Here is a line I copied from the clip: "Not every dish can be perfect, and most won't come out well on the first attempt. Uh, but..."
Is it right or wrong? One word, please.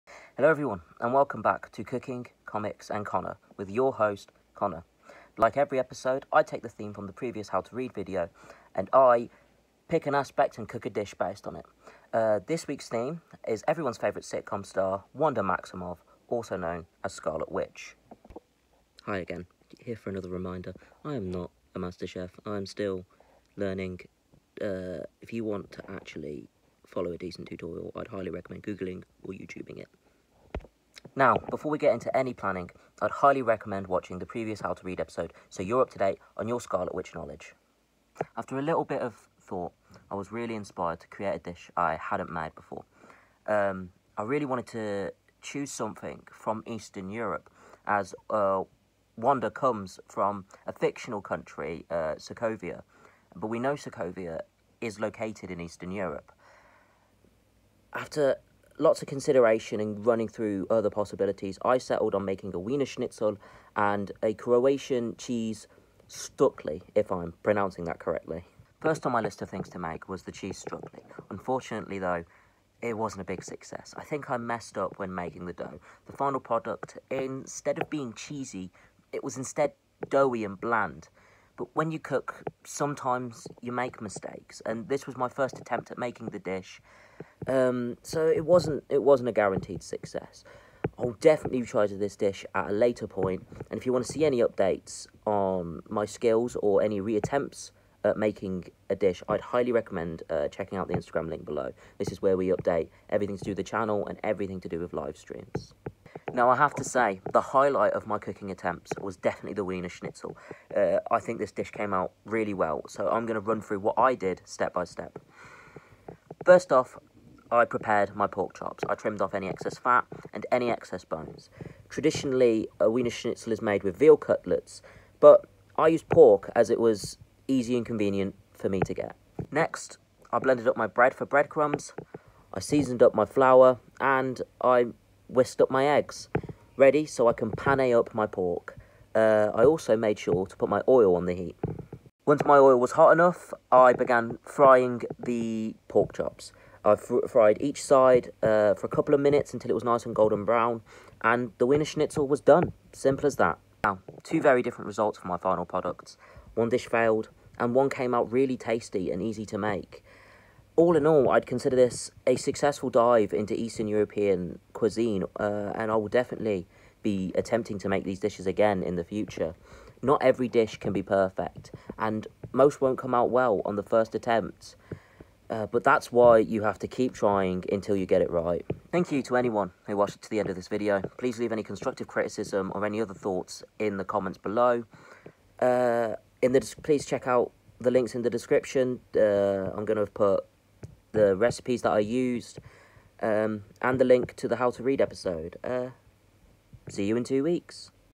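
right.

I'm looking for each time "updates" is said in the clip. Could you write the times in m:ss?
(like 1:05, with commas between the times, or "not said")
1:34, 1:42.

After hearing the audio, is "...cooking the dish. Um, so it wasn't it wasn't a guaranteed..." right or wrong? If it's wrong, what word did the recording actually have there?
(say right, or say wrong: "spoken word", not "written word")
wrong: "making", not "cooking".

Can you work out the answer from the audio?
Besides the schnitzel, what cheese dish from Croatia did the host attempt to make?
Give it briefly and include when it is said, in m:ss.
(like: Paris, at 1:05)
Stukli, at 1:06.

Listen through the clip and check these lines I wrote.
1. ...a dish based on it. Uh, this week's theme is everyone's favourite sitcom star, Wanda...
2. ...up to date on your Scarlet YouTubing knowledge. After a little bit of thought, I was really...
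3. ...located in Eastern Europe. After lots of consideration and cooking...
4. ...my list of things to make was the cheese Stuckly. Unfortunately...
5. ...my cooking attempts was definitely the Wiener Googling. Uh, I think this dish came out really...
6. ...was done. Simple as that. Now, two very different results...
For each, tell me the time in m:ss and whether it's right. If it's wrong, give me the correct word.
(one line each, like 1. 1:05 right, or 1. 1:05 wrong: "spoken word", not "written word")
1. 0:10 right
2. 0:35 wrong: "Witch", not "YouTubing"
3. 0:54 wrong: "running", not "cooking"
4. 1:09 right
5. 1:48 wrong: "Schnitzel", not "Googling"
6. 2:32 right.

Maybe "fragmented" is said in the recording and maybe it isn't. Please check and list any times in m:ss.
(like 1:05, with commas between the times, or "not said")
not said.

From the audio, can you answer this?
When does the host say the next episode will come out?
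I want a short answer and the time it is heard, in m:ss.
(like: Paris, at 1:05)
in two weeks, at 3:17.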